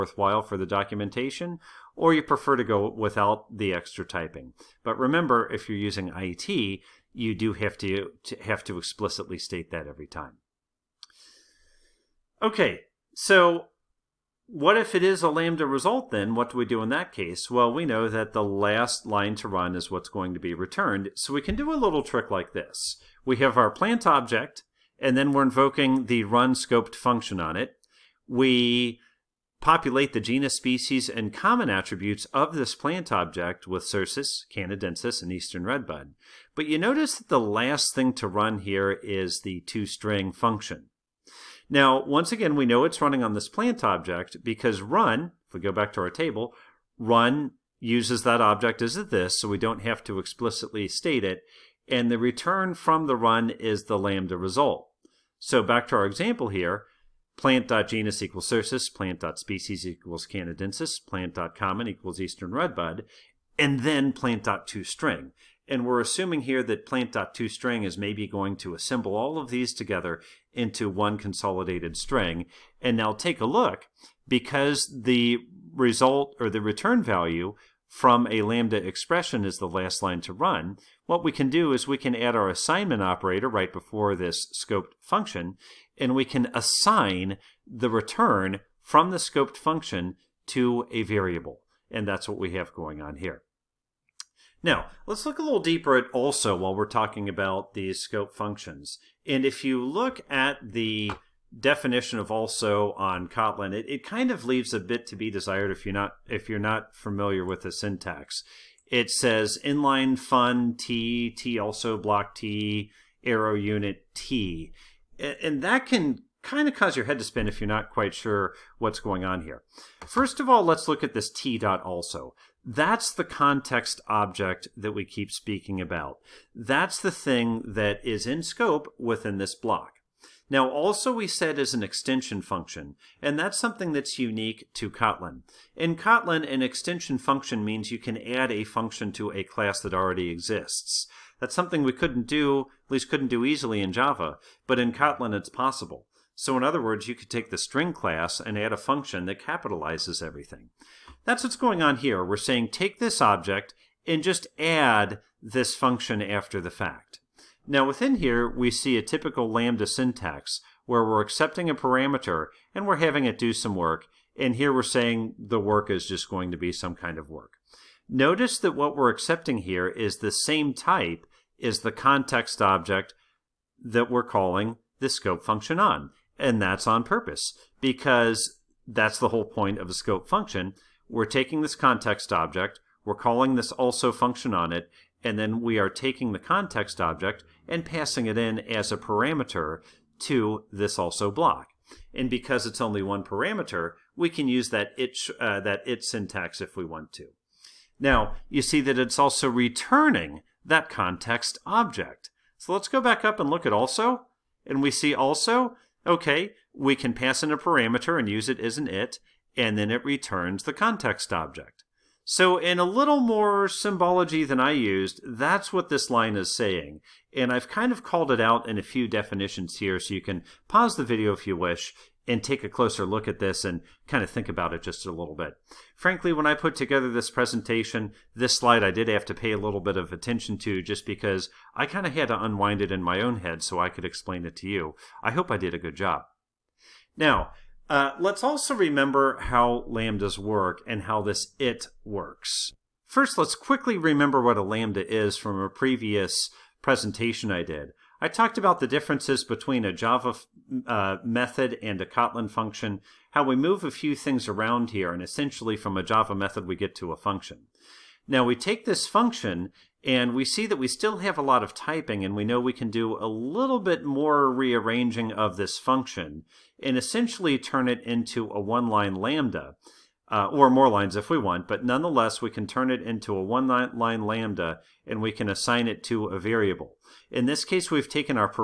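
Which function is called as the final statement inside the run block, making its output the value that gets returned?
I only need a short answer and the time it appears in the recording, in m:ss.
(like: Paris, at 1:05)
toString, at 0:39.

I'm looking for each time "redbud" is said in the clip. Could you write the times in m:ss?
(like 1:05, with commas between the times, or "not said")
0:35, 1:02.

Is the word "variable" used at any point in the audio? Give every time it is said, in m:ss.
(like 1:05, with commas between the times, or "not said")
1:31, 4:36.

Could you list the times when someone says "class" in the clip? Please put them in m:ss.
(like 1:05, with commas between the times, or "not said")
2:19, 2:27.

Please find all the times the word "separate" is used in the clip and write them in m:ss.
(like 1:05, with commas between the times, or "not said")
not said.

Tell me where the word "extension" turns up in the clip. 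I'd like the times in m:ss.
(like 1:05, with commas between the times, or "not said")
2:11, 2:16.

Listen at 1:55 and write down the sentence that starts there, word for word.
And that can kind of cause your head to spin if you're not quite sure what's going on here.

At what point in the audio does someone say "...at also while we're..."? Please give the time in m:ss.
1:35.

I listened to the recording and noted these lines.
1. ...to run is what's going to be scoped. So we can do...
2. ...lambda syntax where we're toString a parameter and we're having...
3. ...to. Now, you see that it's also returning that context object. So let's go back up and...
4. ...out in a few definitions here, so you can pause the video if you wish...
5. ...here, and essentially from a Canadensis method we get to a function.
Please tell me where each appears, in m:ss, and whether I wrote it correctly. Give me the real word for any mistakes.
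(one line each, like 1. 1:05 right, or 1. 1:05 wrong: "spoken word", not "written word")
1. 0:19 wrong: "returned", not "scoped"
2. 2:39 wrong: "accepting", not "toString"
3. 3:17 right
4. 3:38 right
5. 4:14 wrong: "Java", not "Canadensis".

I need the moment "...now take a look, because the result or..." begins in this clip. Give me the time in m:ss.
1:12.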